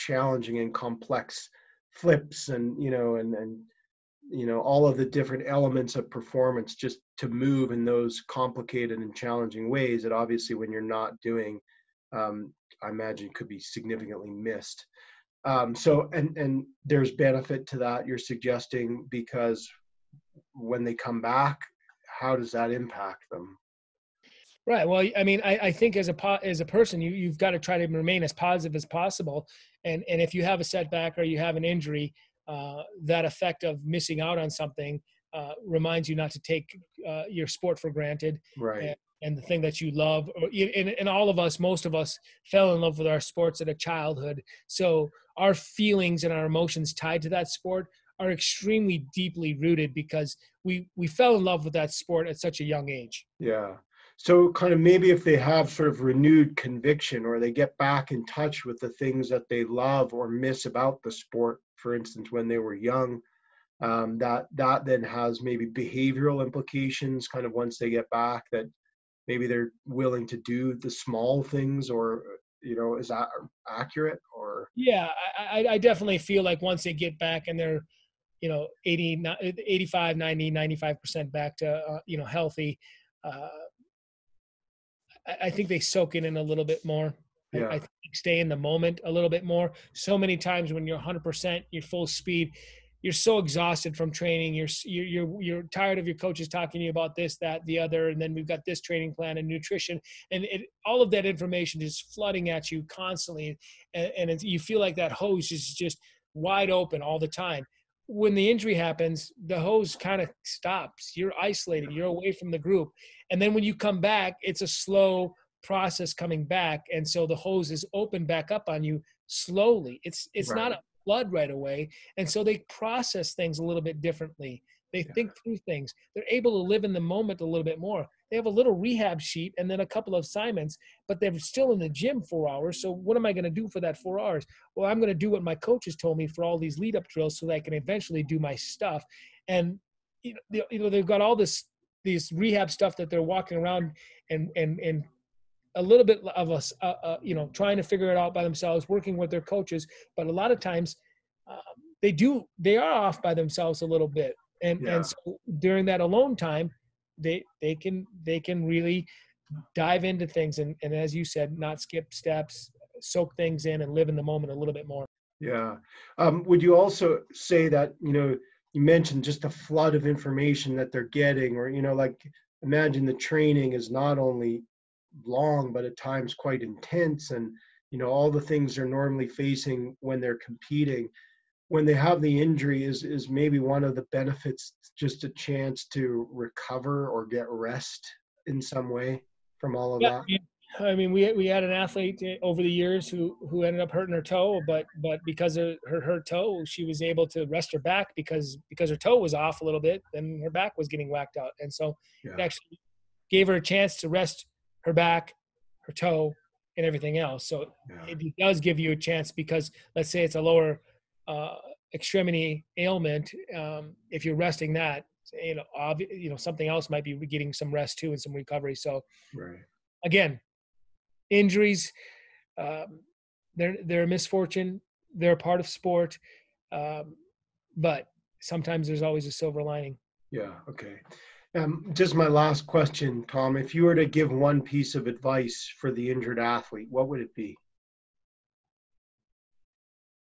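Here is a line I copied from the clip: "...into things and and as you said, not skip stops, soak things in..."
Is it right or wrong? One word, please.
wrong.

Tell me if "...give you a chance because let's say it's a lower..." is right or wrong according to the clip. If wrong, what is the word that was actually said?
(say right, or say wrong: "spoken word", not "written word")
right.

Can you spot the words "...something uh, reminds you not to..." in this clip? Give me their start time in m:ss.
0:34.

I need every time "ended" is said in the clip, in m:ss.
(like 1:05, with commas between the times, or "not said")
3:13.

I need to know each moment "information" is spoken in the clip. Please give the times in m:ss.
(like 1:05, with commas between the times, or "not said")
1:41, 2:50.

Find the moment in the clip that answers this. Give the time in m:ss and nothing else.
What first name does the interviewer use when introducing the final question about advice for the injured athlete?
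3:53.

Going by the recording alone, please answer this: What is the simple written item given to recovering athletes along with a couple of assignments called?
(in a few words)
Rehab sheet.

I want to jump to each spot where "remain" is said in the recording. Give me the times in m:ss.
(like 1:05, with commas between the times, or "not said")
0:27.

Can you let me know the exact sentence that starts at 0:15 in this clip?
Um, so, and and there's benefit to that you're suggesting because when they come back, how does that impact them?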